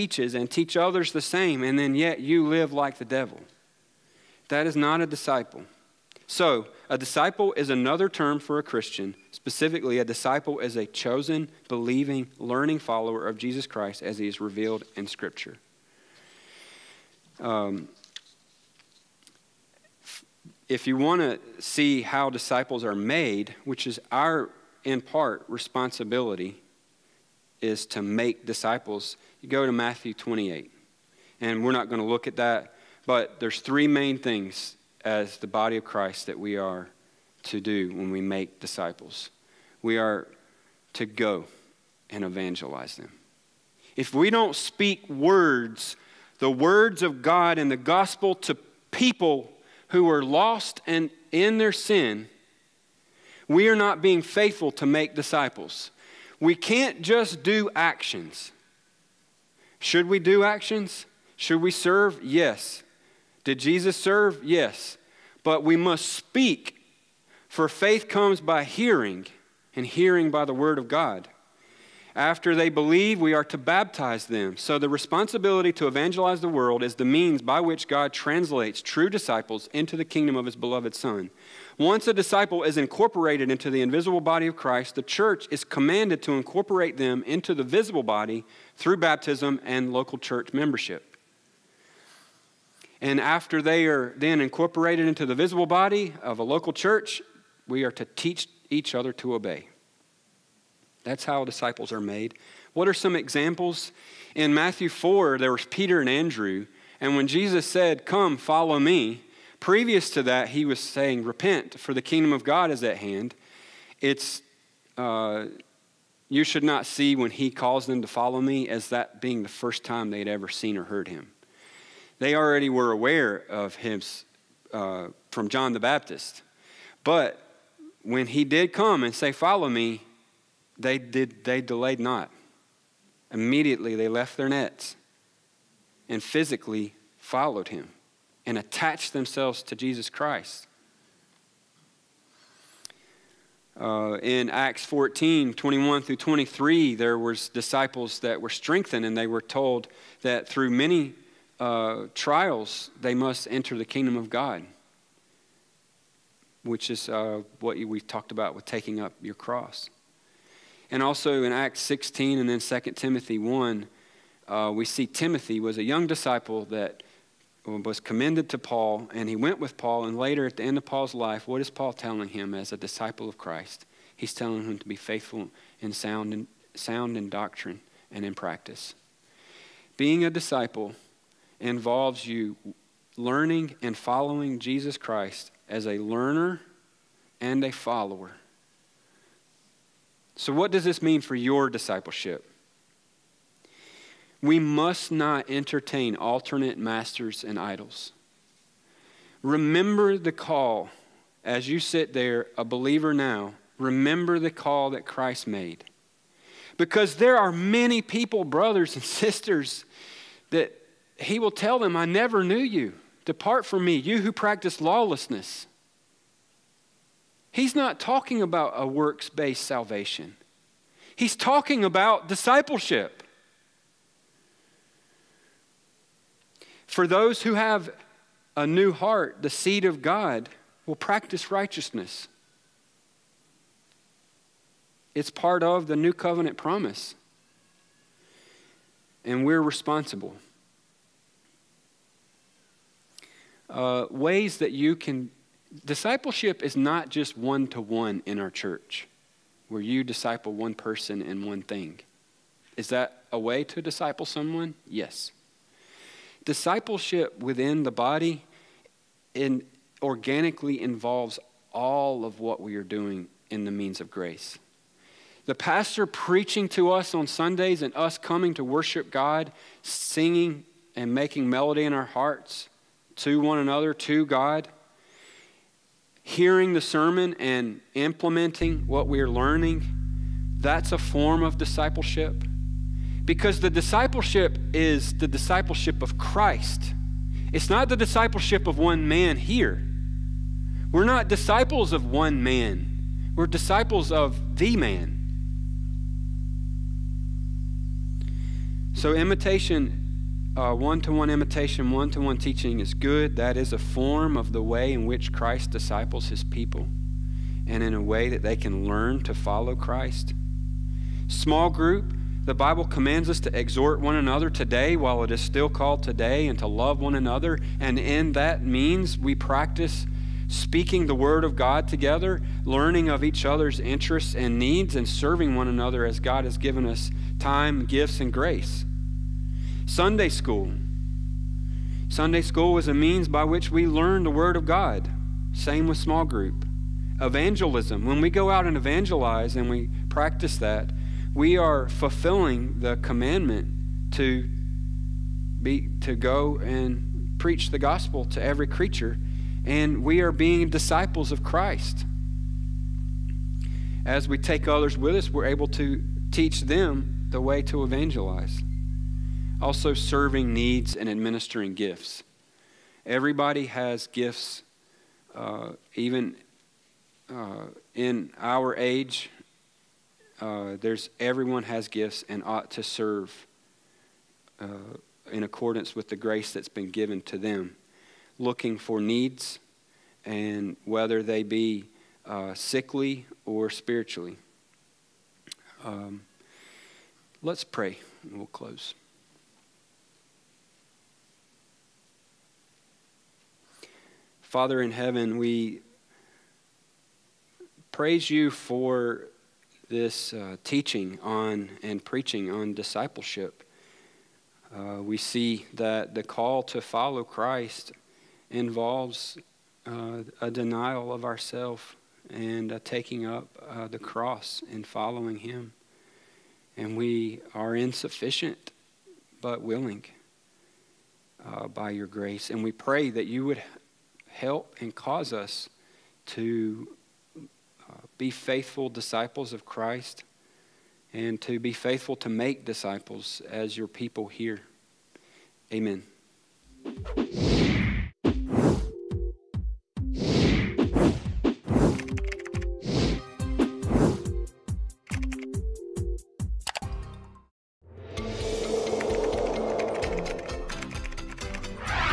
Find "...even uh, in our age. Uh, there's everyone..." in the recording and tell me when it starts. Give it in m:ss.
6:05.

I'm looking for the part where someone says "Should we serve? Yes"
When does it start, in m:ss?
1:01.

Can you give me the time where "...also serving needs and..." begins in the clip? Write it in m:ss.
5:59.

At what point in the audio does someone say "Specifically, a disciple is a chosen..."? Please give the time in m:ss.
0:09.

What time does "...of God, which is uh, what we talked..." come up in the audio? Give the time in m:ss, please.
2:34.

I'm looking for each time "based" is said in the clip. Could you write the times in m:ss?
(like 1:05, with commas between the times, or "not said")
3:39.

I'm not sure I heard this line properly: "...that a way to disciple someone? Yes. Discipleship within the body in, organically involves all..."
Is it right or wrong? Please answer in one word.
right.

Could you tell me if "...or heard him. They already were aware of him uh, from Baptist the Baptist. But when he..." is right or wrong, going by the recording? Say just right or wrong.
wrong.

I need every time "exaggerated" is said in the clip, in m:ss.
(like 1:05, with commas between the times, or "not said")
not said.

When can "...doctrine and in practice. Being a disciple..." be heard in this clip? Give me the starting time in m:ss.
2:57.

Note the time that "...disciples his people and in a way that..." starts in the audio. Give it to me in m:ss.
5:05.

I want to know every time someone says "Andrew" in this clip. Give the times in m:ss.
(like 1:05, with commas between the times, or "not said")
1:46.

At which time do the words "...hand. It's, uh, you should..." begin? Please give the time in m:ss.
1:52.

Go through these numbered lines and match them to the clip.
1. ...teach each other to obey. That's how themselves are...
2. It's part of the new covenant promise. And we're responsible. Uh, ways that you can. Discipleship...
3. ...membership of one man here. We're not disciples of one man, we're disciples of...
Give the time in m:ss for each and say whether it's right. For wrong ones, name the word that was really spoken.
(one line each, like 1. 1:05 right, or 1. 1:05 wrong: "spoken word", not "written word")
1. 1:38 wrong: "disciples", not "themselves"
2. 3:55 right
3. 4:47 wrong: "discipleship", not "membership".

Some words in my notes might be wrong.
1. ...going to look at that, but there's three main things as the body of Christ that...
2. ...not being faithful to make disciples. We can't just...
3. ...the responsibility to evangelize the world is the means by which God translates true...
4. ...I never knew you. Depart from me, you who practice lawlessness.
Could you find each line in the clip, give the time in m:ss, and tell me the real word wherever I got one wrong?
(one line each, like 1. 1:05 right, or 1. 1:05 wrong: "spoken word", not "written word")
1. 0:31 right
2. 0:53 right
3. 1:14 right
4. 3:31 right.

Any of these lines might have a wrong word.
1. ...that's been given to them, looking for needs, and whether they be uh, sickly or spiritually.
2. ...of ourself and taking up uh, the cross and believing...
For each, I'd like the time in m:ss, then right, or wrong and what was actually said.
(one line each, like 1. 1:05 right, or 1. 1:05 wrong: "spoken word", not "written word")
1. 6:16 right
2. 6:51 wrong: "following", not "believing".